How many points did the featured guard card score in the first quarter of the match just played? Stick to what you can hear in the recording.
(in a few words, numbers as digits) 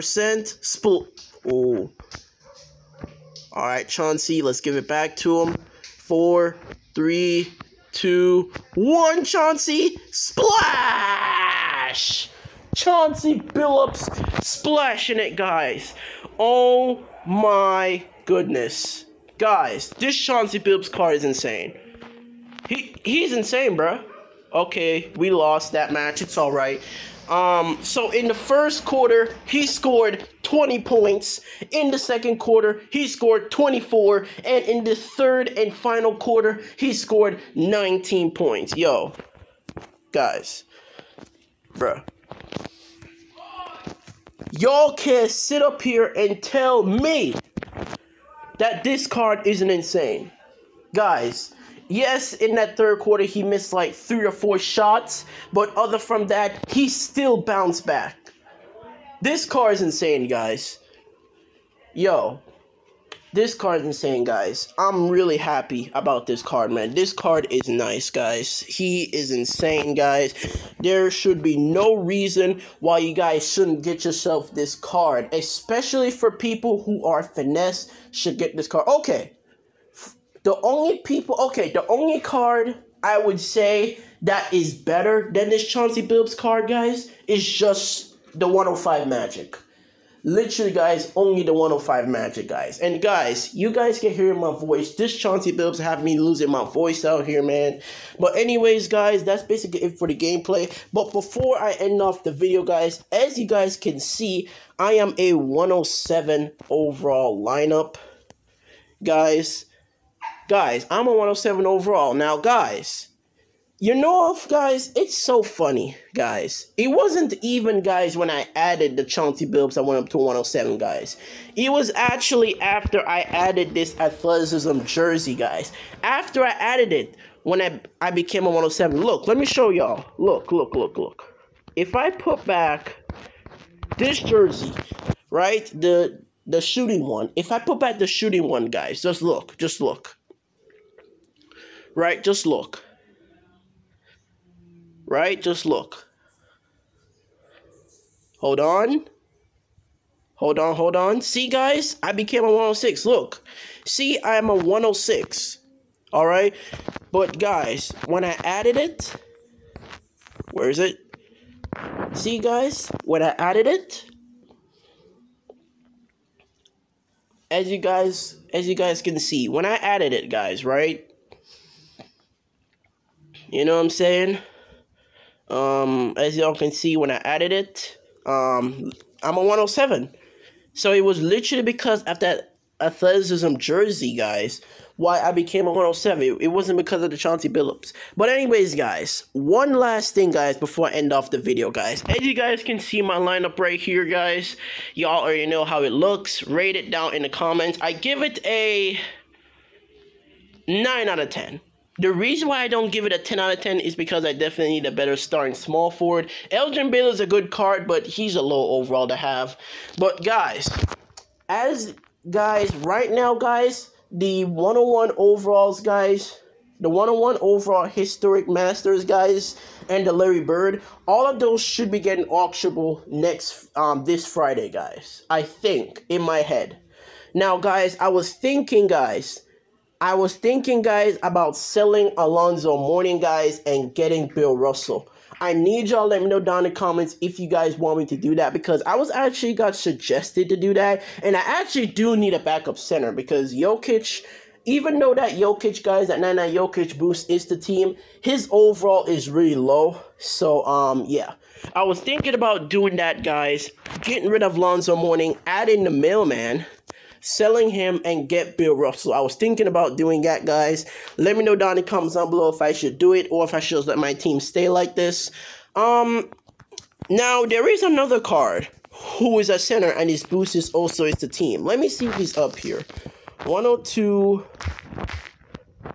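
20.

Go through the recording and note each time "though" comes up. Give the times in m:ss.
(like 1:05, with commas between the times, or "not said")
4:04.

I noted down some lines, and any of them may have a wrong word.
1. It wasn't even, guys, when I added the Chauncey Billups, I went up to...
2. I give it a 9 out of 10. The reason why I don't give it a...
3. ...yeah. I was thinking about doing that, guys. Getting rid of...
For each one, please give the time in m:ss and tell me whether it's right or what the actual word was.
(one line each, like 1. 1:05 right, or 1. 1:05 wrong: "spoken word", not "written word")
1. 1:56 right
2. 3:17 right
3. 4:11 right.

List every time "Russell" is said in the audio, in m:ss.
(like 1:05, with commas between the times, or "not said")
3:54, 4:18.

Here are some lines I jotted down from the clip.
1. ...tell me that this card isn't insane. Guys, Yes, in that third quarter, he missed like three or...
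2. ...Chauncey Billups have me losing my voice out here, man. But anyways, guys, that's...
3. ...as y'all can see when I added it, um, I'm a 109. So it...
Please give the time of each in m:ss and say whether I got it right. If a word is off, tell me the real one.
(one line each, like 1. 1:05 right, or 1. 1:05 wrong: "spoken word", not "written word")
1. 0:46 right
2. 1:35 right
3. 2:56 wrong: "107", not "109".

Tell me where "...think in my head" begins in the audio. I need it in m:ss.
3:45.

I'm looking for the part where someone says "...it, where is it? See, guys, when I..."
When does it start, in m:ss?
2:38.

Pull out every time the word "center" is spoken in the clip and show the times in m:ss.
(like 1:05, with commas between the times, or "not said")
4:02, 4:29.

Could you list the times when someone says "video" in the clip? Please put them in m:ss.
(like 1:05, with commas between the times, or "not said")
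1:42, 3:11.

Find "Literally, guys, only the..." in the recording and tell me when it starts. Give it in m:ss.
1:30.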